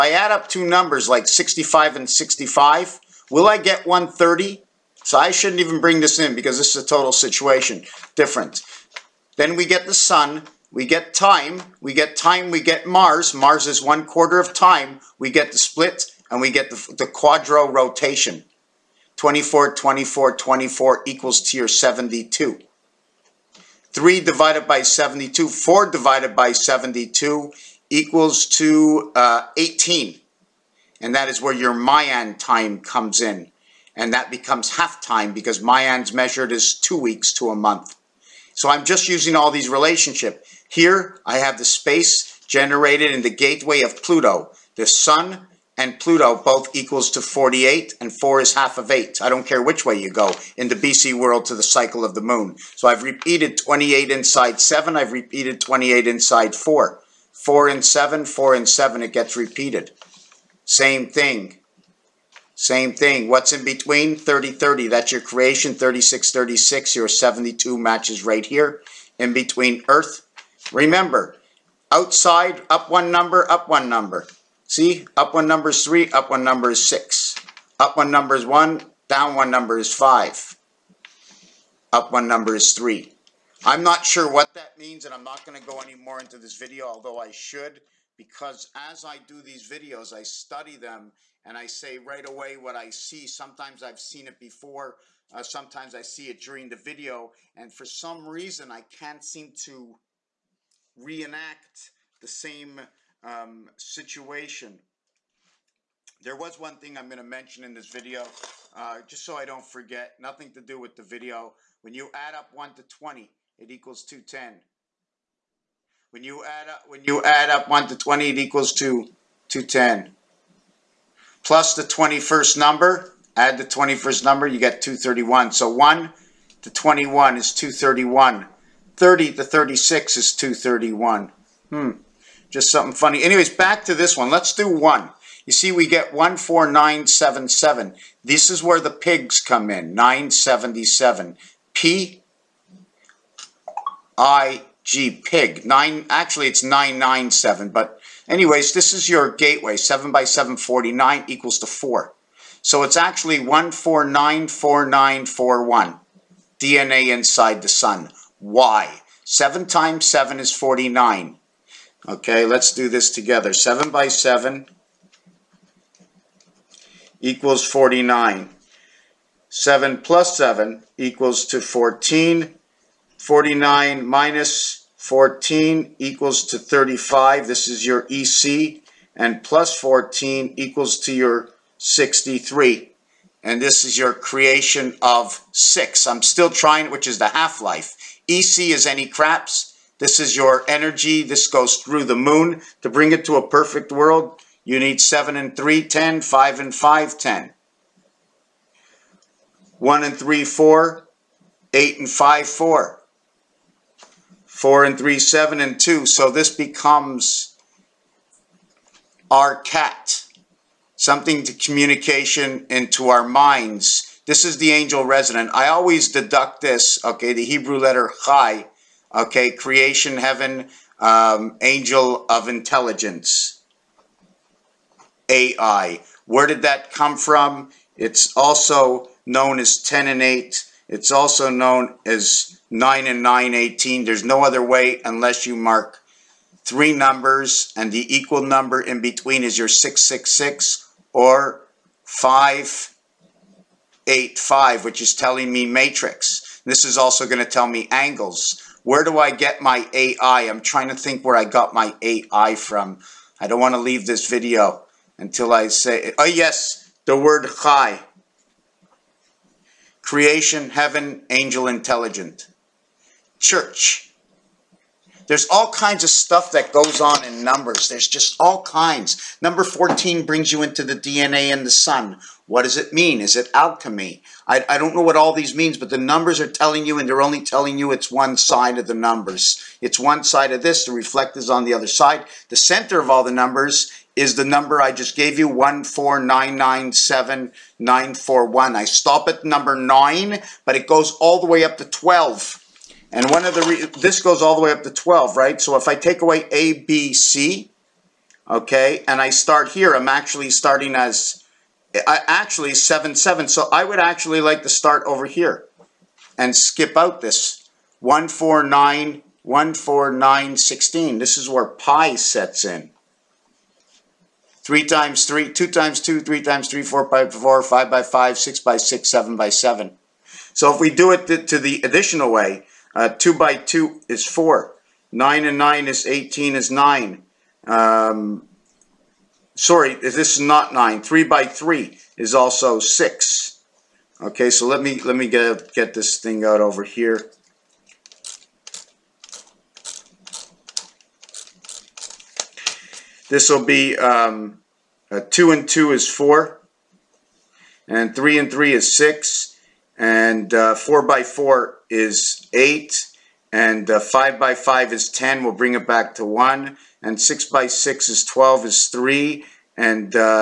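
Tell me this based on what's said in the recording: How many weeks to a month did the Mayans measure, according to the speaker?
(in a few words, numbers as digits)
2.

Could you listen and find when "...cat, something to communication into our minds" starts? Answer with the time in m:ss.
3:29.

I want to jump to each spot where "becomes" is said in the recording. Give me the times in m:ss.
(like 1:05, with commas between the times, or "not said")
0:34, 3:26.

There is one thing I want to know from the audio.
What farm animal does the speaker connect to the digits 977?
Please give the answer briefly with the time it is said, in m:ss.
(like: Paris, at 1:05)
Pig, at 2:18.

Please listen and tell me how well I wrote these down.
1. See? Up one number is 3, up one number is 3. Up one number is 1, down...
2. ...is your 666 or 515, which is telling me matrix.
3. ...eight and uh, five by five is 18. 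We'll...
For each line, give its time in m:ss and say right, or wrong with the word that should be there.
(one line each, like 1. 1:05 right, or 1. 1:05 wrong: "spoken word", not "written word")
1. 1:14 wrong: "6", not "3"
2. 3:59 wrong: "585", not "515"
3. 5:52 wrong: "10", not "18".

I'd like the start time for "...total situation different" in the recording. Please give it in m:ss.
0:06.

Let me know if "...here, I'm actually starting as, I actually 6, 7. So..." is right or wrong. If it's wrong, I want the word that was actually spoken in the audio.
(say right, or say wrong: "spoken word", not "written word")
wrong: "7", not "6".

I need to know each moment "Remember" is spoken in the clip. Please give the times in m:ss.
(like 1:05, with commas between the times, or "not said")
1:10.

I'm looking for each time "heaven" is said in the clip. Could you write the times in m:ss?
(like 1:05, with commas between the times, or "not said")
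3:40, 4:20.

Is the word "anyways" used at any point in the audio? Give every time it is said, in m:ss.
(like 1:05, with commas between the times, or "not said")
2:13, 2:28.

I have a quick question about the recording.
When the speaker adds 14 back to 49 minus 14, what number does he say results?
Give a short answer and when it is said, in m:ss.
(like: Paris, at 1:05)
63, at 3:01.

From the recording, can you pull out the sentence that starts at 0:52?
So I've repeated 28 inside 7.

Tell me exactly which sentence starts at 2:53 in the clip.
49 minus 14 equals to 35.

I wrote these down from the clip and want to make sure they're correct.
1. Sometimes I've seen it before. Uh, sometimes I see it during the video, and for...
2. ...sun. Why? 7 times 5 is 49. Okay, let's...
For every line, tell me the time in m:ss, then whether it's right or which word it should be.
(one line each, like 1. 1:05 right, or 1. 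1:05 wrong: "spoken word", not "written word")
1. 1:33 right
2. 2:37 wrong: "7", not "5".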